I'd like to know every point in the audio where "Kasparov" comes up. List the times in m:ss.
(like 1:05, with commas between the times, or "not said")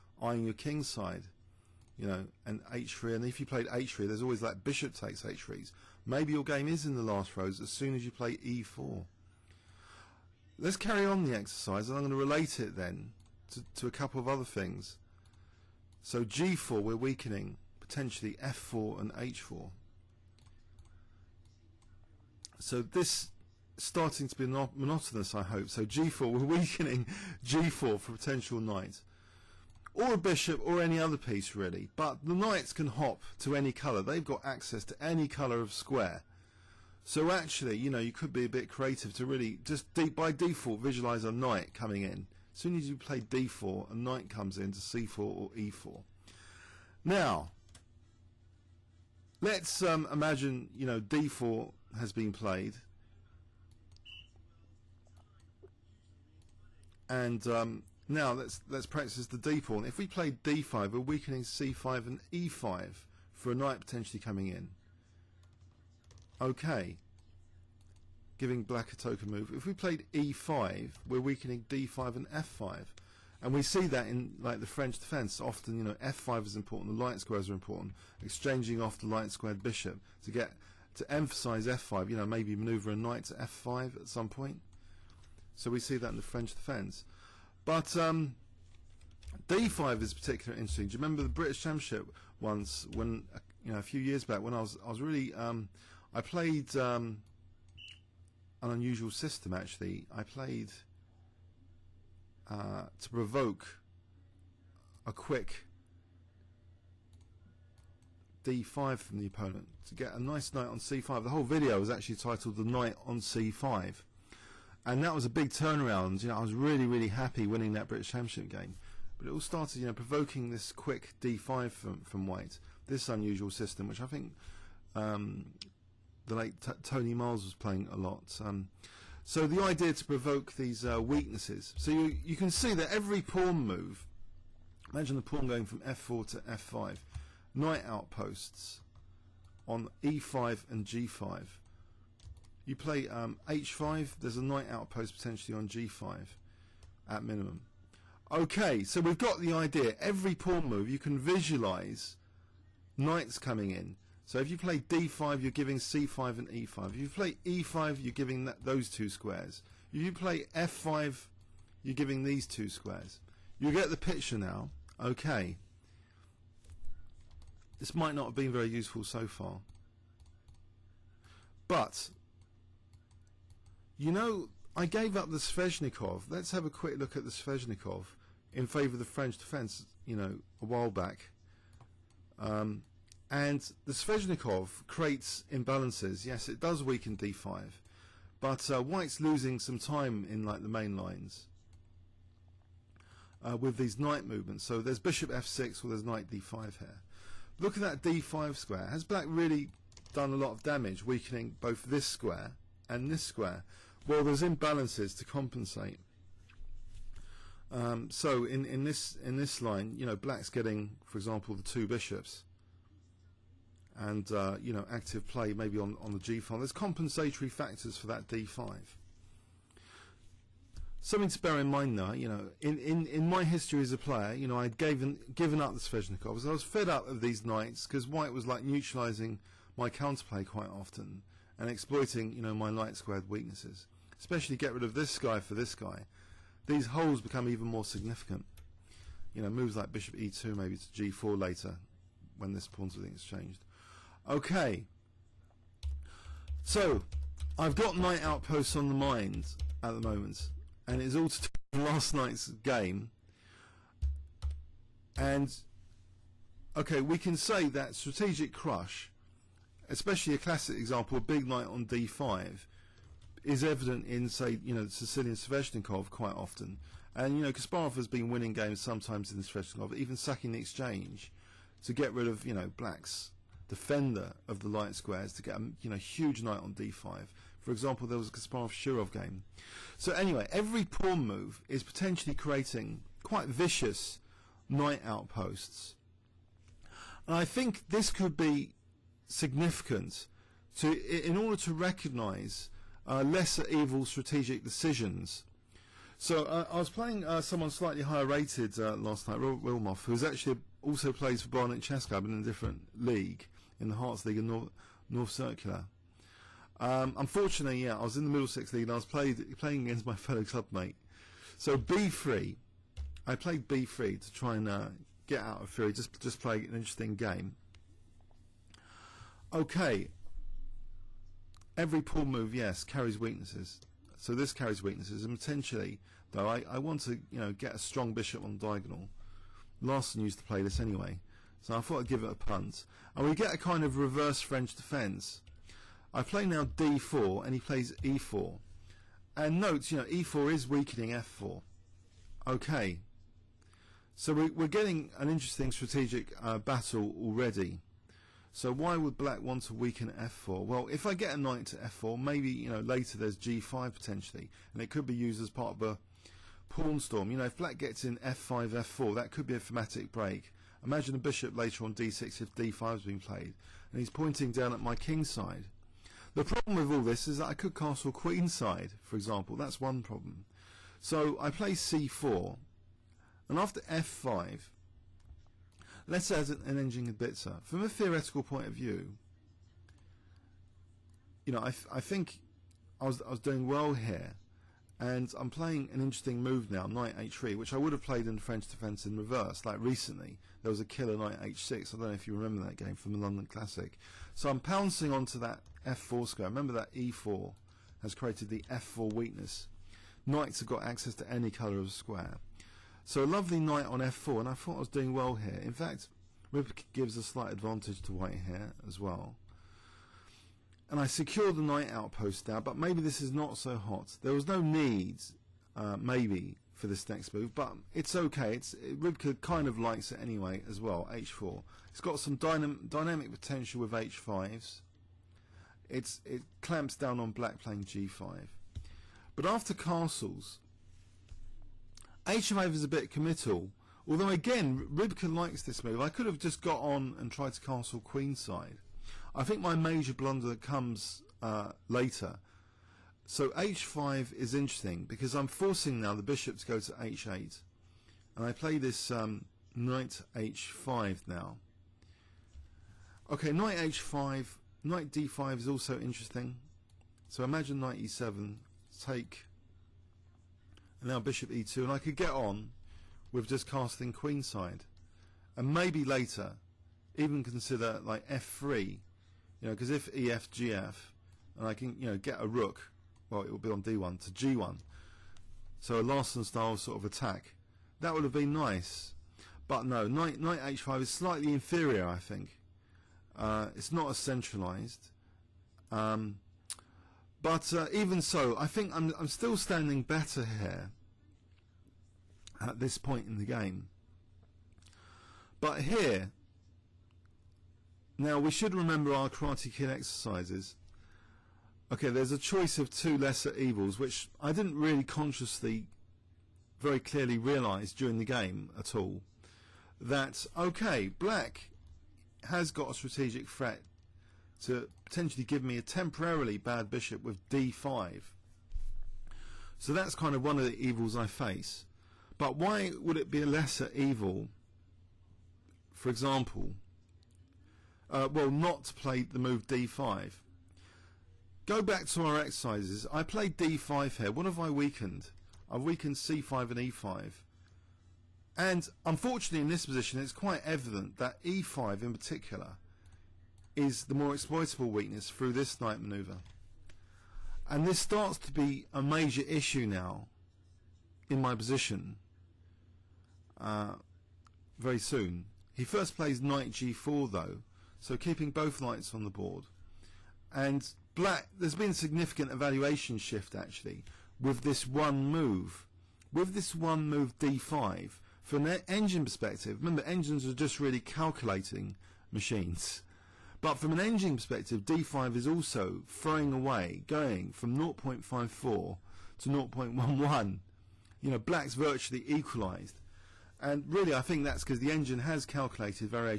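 4:27, 4:38.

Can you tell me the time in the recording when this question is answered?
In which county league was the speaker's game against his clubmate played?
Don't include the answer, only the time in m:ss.
5:08.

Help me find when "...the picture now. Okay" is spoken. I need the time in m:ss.
2:43.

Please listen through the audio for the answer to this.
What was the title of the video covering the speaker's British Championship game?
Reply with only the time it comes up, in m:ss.
1:52.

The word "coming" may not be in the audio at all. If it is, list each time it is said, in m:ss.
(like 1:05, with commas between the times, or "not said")
0:41, 1:04, 2:33.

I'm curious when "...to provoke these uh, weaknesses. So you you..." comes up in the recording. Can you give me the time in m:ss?
2:09.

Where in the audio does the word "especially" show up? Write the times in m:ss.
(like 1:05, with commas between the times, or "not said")
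3:54, 4:19.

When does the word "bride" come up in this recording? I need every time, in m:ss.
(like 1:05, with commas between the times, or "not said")
not said.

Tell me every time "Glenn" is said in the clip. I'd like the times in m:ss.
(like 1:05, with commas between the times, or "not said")
not said.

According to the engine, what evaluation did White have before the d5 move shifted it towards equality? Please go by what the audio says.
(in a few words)
0.54.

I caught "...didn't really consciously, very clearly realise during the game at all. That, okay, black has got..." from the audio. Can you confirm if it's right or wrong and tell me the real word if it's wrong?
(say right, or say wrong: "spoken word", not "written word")
right.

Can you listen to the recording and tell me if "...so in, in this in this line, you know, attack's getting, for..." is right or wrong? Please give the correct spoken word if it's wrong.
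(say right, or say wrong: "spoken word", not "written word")
wrong: "black", not "attack".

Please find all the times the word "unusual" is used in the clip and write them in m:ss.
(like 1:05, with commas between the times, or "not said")
1:38, 2:03.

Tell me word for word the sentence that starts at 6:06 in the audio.
The problem with all this is that I could castle queenside, for example.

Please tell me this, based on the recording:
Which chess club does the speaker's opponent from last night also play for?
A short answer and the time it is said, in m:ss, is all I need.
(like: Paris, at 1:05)
Barnet, at 5:01.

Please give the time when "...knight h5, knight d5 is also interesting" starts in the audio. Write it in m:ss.
7:33.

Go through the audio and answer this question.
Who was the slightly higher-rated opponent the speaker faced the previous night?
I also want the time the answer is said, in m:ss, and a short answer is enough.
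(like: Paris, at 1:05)
Robert Willmoth, at 4:59.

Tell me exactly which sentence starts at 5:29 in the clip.
Larsen used to play this anyway, so I thought I'd give it a punt.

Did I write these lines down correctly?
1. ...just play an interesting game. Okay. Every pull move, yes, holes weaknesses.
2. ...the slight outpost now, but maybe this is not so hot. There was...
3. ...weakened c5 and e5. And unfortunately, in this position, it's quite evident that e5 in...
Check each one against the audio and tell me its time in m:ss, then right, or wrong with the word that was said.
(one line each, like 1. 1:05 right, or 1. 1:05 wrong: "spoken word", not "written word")
1. 5:16 wrong: "carries", not "holes"
2. 6:51 wrong: "knight", not "slight"
3. 8:55 right.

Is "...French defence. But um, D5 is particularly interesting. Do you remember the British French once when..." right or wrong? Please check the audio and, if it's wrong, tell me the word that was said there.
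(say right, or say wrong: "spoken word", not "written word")
wrong: "Championship", not "French".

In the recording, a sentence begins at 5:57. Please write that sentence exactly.
You know, if black gets in f5, f4, that could be a thematic break.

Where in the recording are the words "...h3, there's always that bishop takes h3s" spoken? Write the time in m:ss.
0:03.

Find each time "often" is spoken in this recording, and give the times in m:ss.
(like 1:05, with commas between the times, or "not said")
1:15, 3:50, 4:26.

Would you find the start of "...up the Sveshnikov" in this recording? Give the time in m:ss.
2:55.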